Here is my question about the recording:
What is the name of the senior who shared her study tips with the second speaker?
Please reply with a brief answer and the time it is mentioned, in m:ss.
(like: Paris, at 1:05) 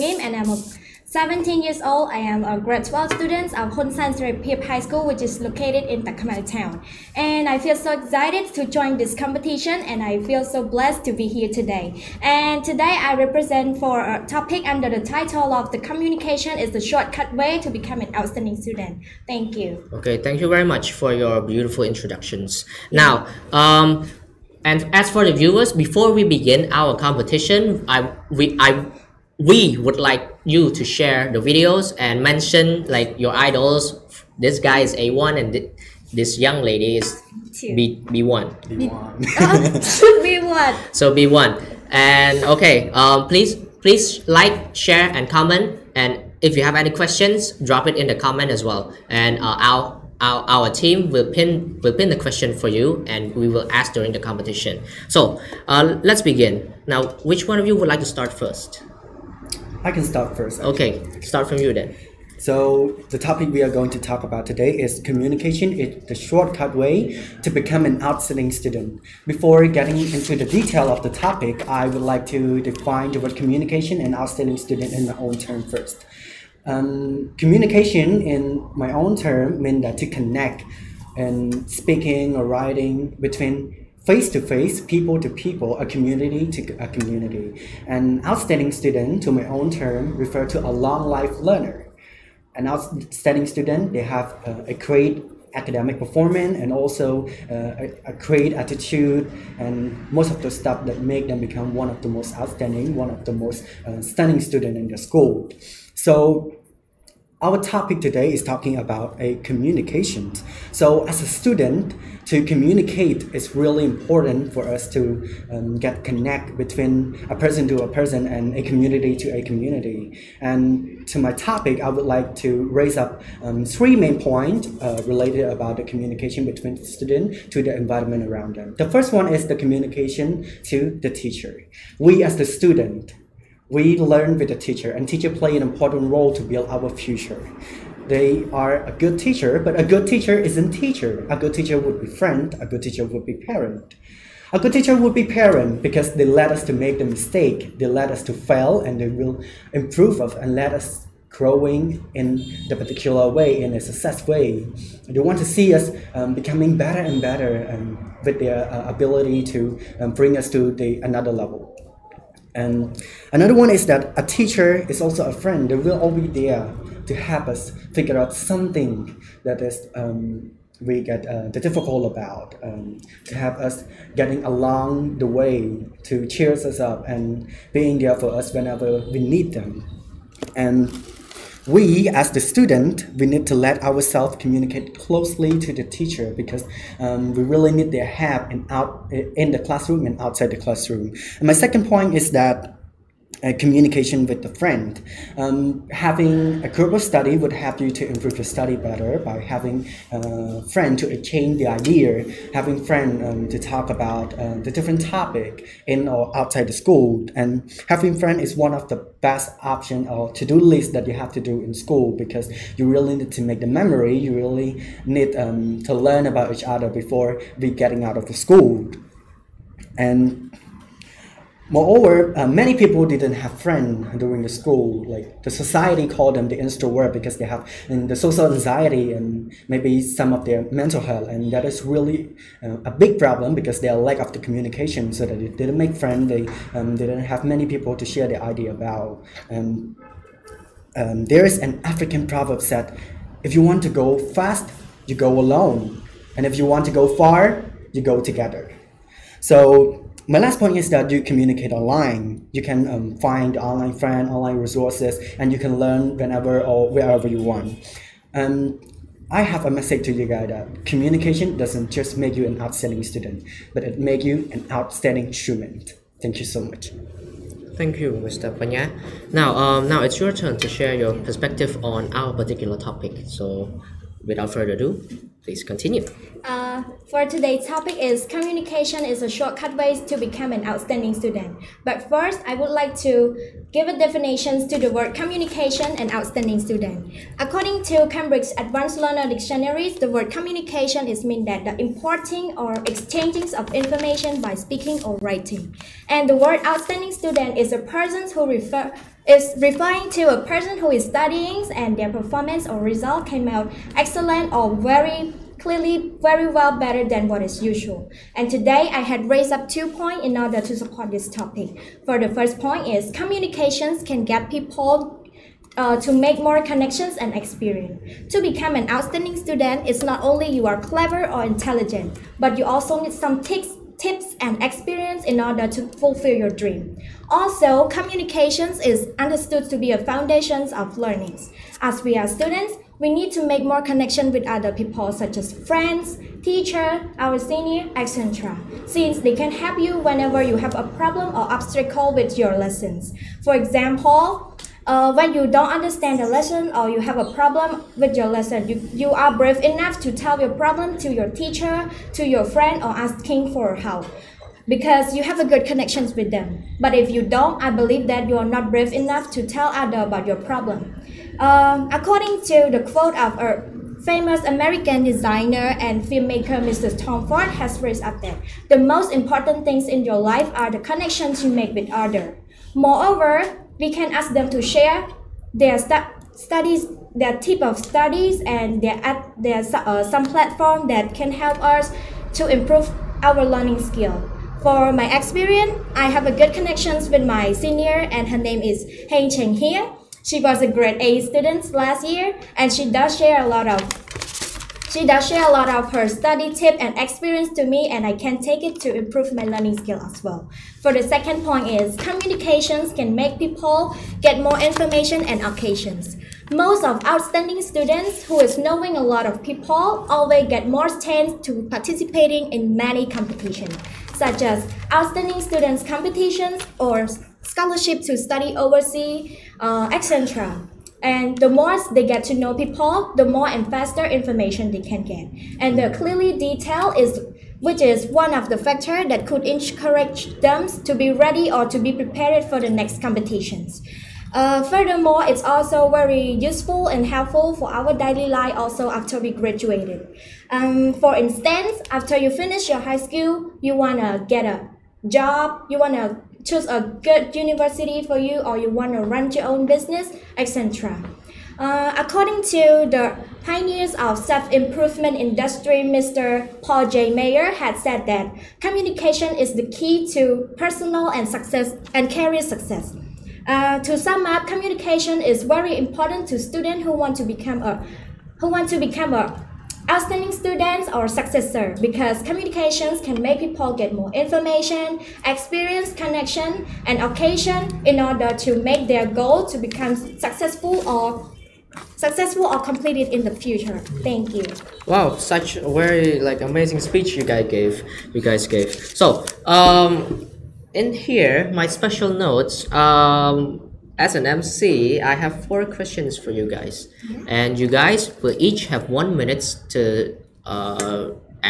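Heng Cheng, at 6:29.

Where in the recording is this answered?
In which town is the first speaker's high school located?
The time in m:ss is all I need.
0:06.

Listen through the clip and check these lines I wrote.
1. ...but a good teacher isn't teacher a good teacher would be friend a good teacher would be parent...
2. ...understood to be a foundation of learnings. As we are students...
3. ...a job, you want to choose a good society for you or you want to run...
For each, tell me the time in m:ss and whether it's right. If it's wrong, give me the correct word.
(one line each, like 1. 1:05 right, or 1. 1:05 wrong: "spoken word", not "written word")
1. 2:19 right
2. 5:29 right
3. 7:24 wrong: "university", not "society".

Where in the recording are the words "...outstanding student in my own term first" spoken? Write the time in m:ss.
1:14.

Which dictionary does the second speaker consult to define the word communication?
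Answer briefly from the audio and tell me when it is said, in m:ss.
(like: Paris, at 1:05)
Cambridge Advanced Learner Dictionaries, at 4:48.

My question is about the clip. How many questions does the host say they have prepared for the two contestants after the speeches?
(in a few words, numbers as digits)
4.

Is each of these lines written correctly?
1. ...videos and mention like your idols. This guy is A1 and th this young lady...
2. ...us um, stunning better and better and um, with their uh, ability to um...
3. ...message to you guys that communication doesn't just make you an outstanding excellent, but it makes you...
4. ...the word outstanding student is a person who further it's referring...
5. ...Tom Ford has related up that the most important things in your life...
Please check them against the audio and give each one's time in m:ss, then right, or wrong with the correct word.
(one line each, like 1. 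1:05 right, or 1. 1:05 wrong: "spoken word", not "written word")
1. 0:31 right
2. 2:35 wrong: "becoming", not "stunning"
3. 4:19 wrong: "student", not "excellent"
4. 4:56 wrong: "refer", not "further"
5. 6:06 wrong: "raised", not "related".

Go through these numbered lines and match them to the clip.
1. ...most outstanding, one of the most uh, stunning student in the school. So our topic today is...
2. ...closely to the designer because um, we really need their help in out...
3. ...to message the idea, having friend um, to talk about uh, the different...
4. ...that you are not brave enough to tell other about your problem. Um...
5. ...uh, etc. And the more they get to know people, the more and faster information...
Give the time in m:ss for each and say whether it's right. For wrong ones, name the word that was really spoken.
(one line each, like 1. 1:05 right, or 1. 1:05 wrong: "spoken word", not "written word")
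1. 1:42 right
2. 3:04 wrong: "teacher", not "designer"
3. 3:20 wrong: "exchange", not "message"
4. 5:58 right
5. 6:59 right.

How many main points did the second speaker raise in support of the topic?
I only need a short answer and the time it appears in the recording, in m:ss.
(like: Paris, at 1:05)
2, at 5:09.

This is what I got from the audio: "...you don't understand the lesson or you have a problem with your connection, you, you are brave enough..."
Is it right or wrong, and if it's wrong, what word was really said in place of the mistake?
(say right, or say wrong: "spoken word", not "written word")
wrong: "lesson", not "connection".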